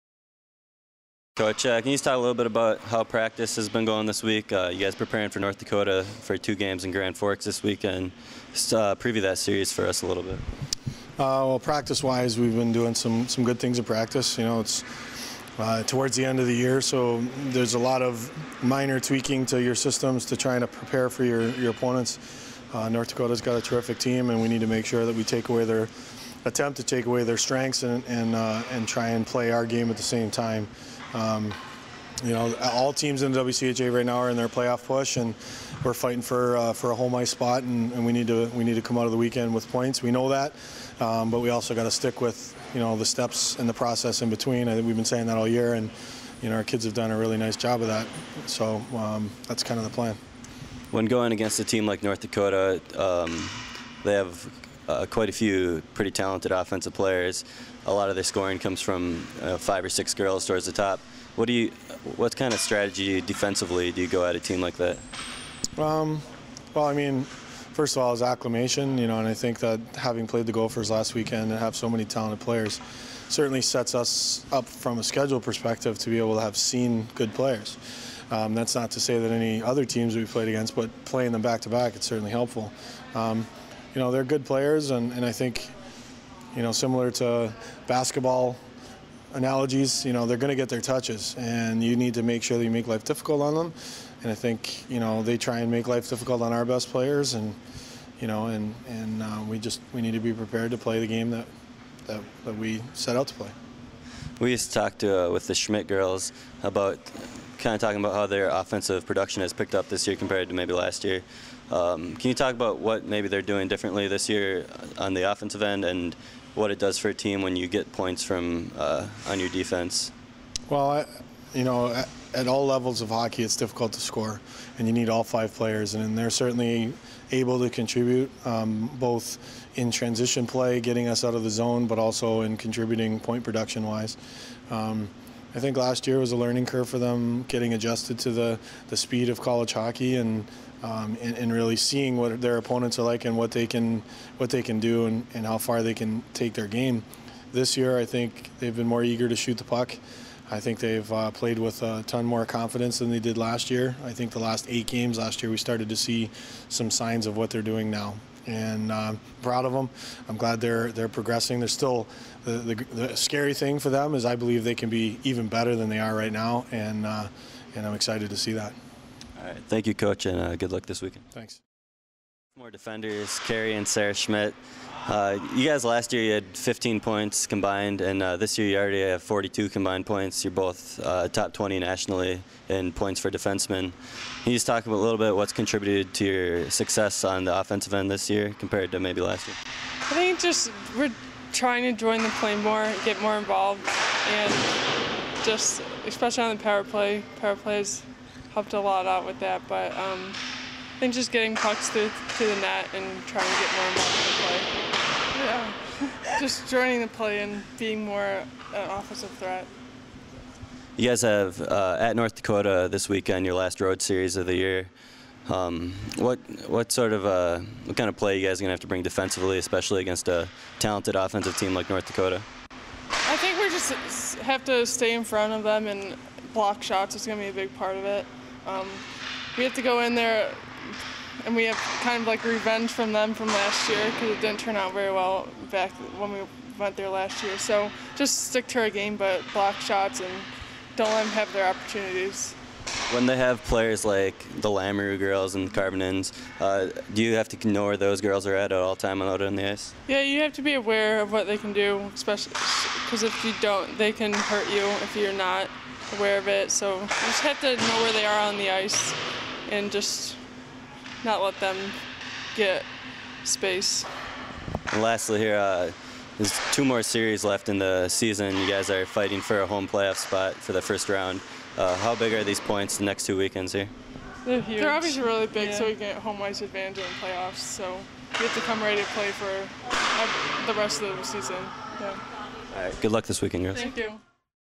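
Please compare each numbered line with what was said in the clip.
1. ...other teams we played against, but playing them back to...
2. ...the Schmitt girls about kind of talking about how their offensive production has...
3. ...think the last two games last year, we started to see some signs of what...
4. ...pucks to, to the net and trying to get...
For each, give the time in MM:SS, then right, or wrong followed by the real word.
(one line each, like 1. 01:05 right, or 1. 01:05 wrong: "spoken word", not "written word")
1. 01:19 right
2. 01:45 right
3. 02:34 wrong: "eight", not "two"
4. 03:21 right.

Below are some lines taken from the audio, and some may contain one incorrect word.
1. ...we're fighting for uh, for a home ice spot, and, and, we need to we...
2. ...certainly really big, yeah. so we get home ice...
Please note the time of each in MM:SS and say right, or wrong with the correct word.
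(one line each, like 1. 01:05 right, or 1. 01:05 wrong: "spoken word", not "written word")
1. 00:35 right
2. 04:34 wrong: "obviously", not "certainly".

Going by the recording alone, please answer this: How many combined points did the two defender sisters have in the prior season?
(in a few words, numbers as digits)
15.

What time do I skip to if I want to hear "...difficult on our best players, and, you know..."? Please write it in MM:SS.
01:36.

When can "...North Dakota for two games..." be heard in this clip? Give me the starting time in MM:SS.
00:05.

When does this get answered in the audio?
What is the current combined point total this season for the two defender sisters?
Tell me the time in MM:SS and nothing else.
02:59.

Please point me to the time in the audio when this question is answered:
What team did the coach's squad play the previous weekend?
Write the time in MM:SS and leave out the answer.
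01:10.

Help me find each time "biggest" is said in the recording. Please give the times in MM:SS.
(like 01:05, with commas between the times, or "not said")
not said.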